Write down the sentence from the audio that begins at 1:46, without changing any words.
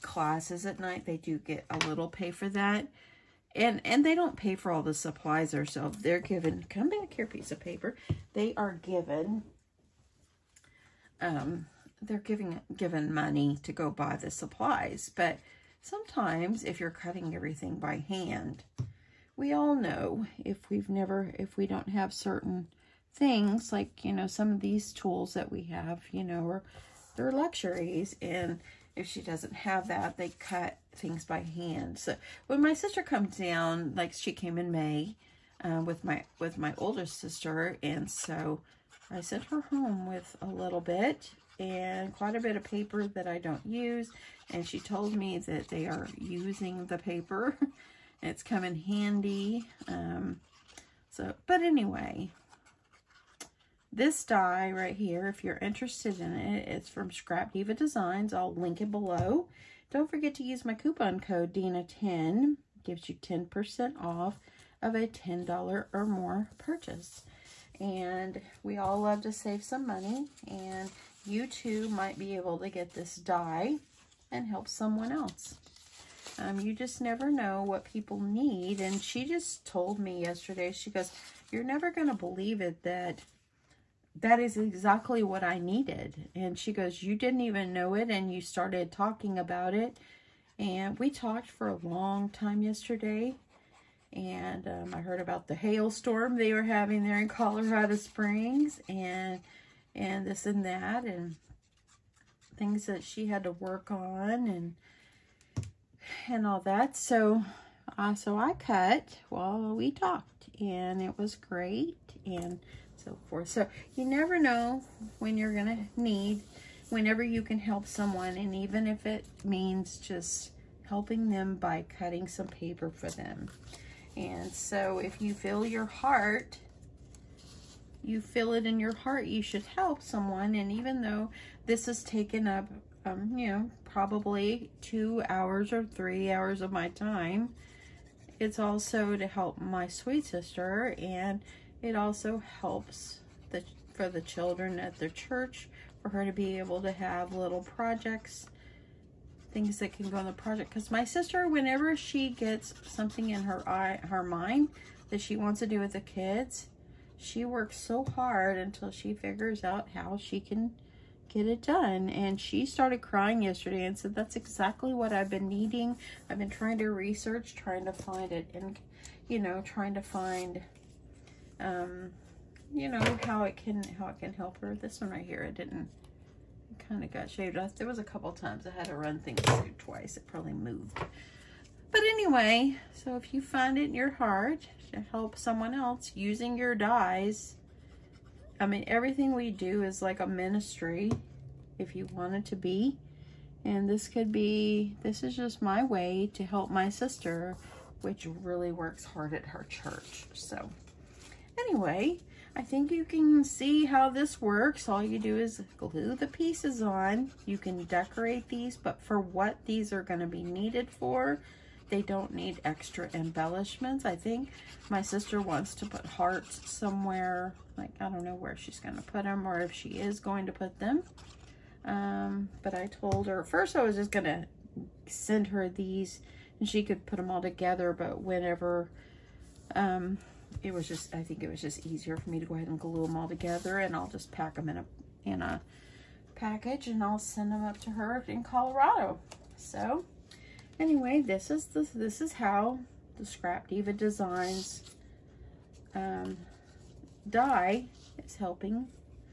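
So, uh, so I cut while we talked and it was great.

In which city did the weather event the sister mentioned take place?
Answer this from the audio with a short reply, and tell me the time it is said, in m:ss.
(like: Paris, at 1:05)
Colorado Springs, at 1:37.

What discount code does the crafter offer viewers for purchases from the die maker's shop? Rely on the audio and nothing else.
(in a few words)
DEANNA10.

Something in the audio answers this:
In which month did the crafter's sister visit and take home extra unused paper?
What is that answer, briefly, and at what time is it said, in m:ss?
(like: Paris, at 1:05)
May, at 0:34.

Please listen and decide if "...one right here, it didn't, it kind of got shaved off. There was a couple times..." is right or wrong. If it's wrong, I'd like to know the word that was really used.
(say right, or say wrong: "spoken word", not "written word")
right.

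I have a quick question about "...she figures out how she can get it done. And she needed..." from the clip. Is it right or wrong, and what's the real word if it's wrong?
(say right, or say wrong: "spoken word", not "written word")
wrong: "started", not "needed".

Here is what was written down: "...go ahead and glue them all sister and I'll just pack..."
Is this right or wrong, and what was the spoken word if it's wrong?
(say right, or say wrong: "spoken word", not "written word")
wrong: "together", not "sister".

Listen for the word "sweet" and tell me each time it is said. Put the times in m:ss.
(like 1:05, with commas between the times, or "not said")
2:19.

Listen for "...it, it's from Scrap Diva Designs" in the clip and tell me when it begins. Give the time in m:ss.
0:56.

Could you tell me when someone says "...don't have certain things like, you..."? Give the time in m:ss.
0:21.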